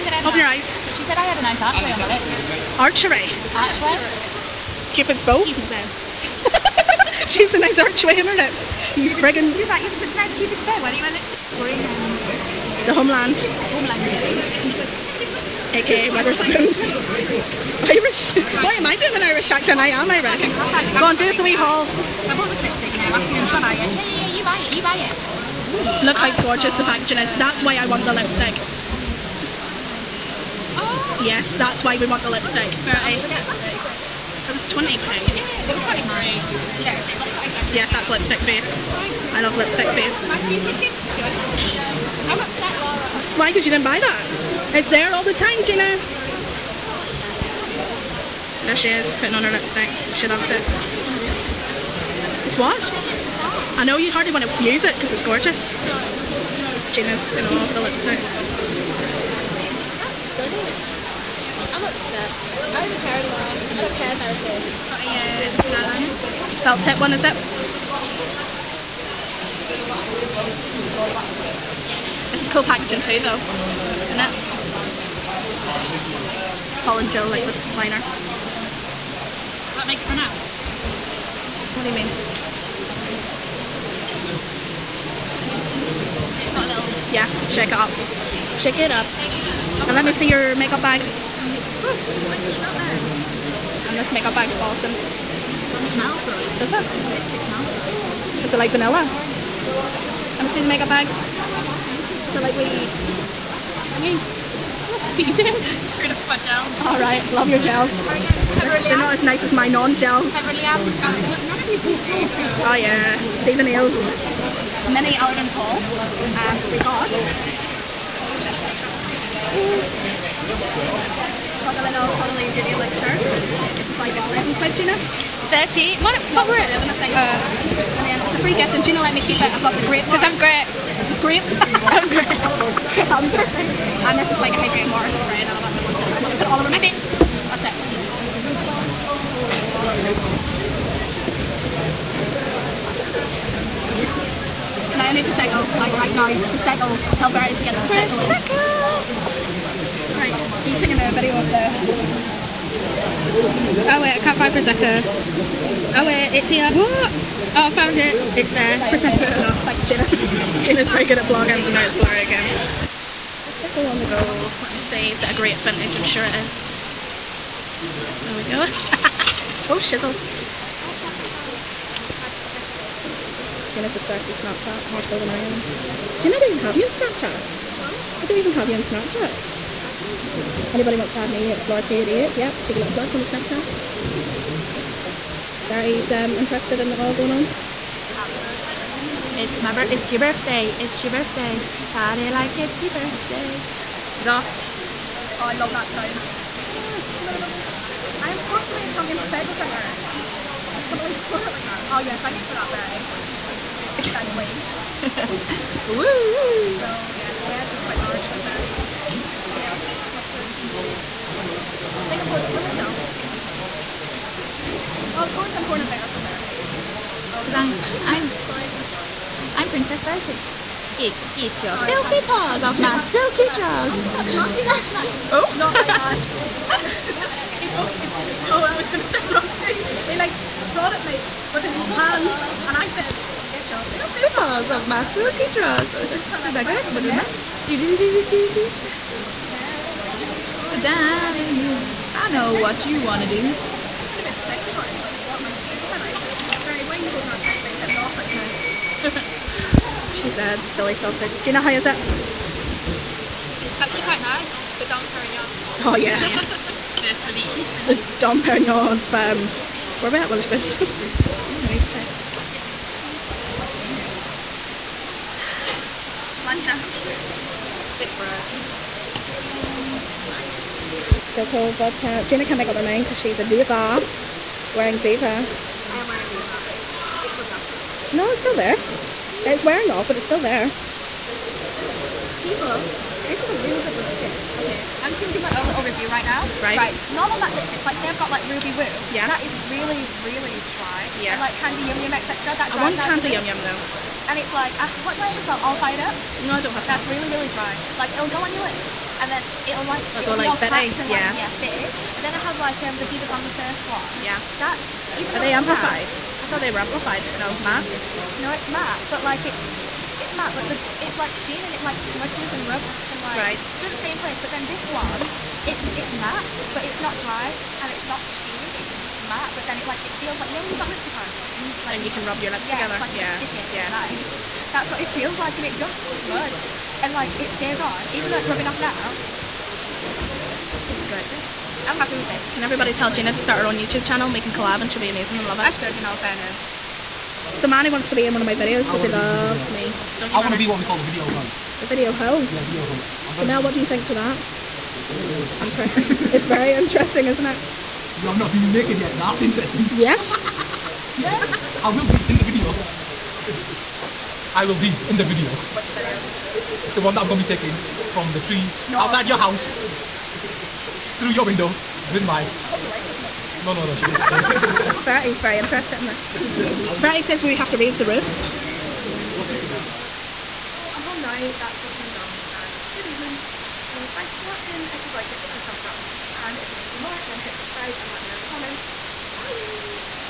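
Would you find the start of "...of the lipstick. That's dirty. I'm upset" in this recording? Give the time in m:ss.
0:57.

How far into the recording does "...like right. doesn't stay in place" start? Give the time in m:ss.
5:13.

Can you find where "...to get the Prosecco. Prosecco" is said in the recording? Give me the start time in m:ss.
2:27.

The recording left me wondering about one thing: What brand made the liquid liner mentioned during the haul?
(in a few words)
Paul and Joe.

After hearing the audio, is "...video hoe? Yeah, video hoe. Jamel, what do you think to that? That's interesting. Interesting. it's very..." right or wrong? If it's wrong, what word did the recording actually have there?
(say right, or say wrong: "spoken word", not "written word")
right.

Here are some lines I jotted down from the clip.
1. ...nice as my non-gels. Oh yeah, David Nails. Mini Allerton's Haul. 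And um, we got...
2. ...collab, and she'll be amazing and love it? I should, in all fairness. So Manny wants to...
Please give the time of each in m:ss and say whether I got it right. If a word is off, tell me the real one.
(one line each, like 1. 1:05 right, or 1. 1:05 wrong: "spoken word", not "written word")
1. 1:49 right
2. 5:34 right.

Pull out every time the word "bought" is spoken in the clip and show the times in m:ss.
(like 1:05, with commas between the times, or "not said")
0:22.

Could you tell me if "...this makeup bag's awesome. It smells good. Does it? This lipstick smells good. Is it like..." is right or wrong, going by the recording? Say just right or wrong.
right.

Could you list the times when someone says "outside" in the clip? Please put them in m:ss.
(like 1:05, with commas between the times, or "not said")
5:58.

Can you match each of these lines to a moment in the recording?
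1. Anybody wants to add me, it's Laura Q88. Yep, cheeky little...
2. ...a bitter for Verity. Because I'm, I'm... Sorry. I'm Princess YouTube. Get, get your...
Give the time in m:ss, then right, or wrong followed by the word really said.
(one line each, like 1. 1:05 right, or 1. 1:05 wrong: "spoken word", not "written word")
1. 3:00 right
2. 3:35 wrong: "Verity", not "YouTube".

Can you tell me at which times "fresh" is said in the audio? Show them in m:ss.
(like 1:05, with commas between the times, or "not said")
4:28.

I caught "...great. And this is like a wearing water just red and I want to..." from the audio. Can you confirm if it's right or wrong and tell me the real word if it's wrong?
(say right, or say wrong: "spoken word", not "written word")
wrong: "hydrating", not "wearing".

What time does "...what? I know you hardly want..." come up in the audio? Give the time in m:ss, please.
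0:52.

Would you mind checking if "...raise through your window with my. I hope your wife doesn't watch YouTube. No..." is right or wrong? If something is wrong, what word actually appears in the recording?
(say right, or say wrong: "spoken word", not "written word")
wrong: "house", not "raise".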